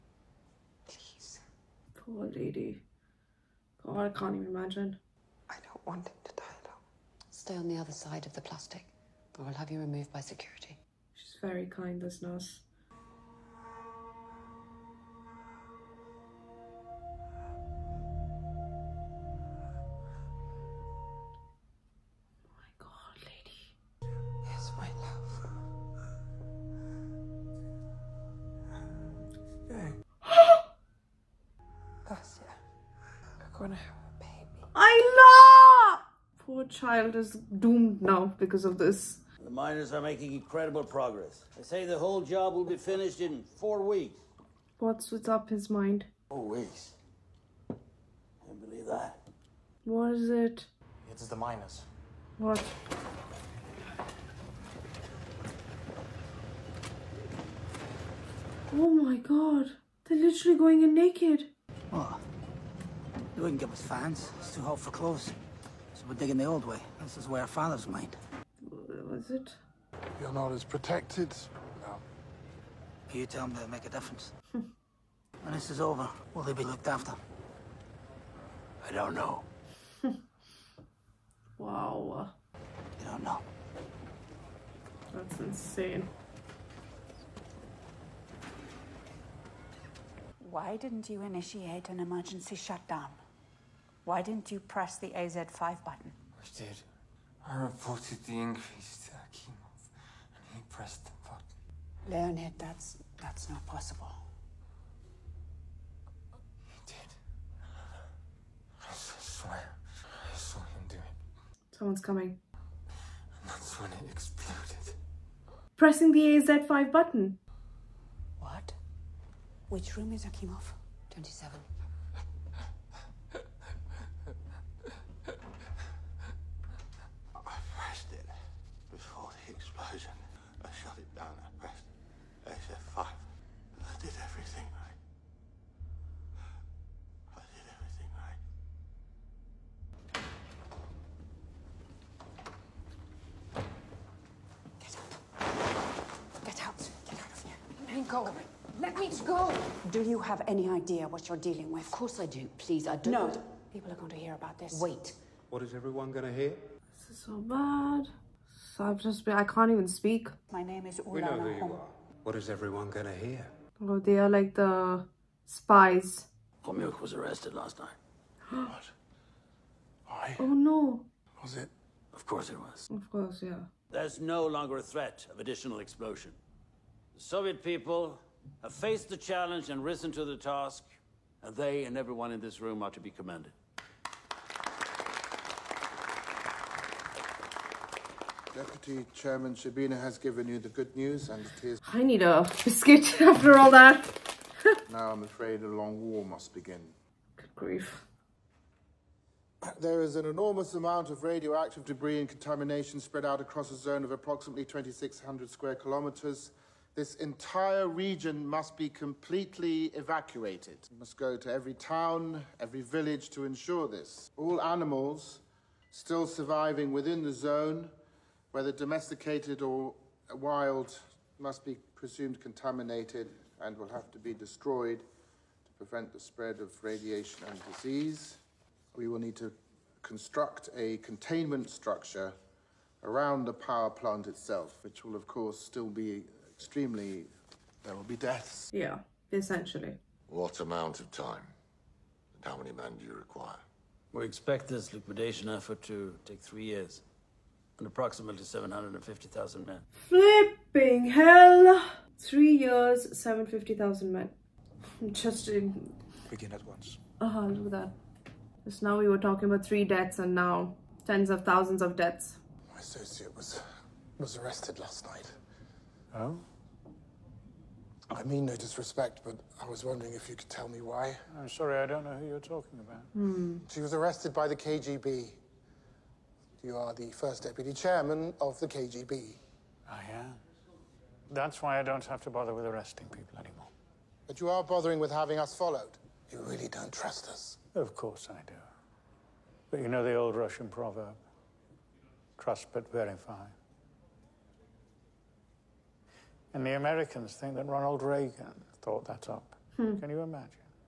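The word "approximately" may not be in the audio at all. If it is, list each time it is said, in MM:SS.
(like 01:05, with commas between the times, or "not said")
03:24, 04:07.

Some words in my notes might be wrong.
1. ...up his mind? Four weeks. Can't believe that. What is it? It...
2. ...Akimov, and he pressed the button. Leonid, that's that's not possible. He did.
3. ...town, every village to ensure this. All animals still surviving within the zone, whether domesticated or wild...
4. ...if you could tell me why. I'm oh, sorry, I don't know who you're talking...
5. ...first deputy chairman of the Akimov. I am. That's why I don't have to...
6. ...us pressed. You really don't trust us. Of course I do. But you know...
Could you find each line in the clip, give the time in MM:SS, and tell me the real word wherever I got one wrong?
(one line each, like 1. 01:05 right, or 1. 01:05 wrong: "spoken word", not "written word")
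1. 00:45 right
2. 01:39 right
3. 03:31 right
4. 04:30 right
5. 04:37 wrong: "KGB", not "Akimov"
6. 04:45 wrong: "followed", not "pressed".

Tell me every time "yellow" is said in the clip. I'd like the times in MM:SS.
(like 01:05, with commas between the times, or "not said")
not said.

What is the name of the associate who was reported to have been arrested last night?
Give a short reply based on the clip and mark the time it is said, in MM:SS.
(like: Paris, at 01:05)
Khomyuk, at 02:46.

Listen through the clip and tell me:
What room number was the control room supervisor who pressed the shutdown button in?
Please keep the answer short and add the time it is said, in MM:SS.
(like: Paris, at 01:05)
27, at 02:01.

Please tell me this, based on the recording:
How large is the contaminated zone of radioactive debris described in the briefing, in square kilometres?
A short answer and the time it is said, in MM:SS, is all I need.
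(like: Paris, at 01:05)
2,600 square kilometres, at 03:24.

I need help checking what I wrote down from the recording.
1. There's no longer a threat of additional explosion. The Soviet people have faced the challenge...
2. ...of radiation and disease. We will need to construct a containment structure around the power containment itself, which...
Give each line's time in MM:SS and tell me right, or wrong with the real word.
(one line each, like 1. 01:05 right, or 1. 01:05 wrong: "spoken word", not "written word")
1. 02:53 right
2. 03:46 wrong: "plant", not "containment".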